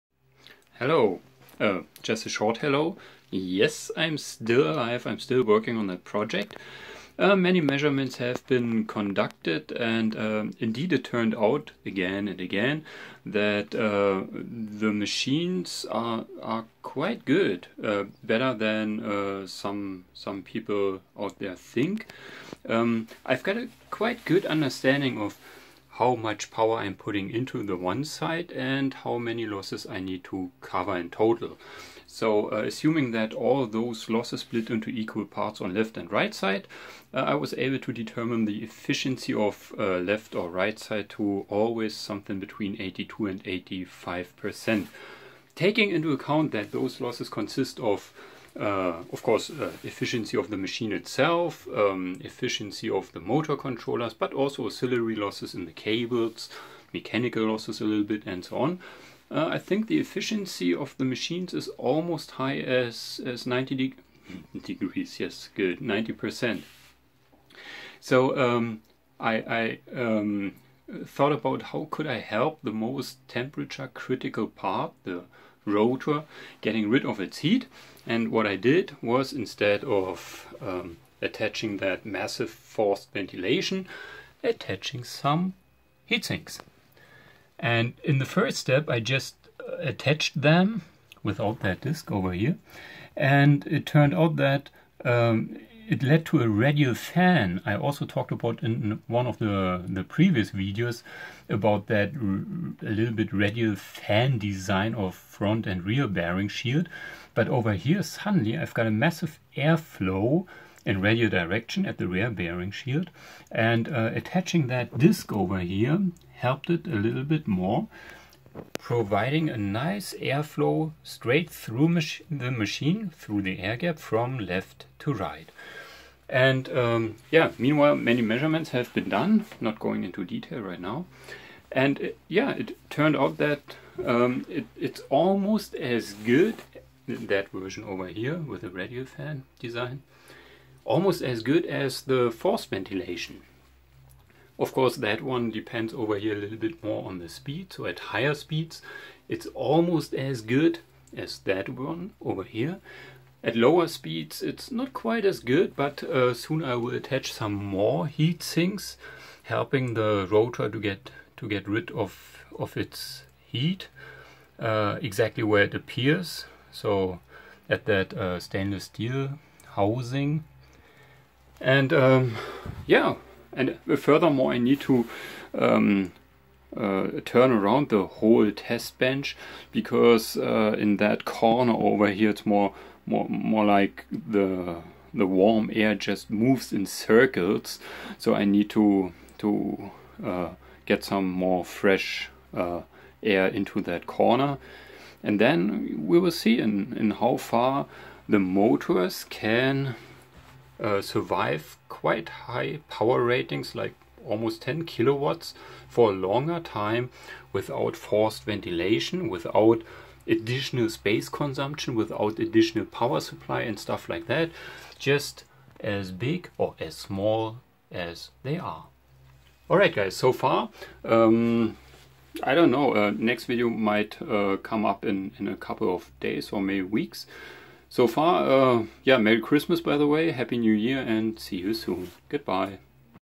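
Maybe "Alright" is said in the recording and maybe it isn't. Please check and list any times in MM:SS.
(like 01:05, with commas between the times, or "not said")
03:39.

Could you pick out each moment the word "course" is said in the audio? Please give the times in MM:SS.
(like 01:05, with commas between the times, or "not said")
00:49, 02:24.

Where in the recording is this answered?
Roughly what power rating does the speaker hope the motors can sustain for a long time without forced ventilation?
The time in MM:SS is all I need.
03:24.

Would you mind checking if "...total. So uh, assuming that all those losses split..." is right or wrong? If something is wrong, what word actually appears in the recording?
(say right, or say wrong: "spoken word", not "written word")
right.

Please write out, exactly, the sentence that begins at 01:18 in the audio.
And what I did was instead of um, attaching that massive forced ventilation, attaching some heat sinks.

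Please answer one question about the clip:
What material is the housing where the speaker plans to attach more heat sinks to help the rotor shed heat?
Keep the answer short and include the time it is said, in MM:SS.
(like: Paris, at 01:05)
Stainless steel, at 02:48.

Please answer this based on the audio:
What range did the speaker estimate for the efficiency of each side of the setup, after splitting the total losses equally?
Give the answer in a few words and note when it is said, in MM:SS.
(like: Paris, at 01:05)
82 to 85%, at 00:42.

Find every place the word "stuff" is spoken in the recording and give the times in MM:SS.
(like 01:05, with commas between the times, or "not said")
03:33.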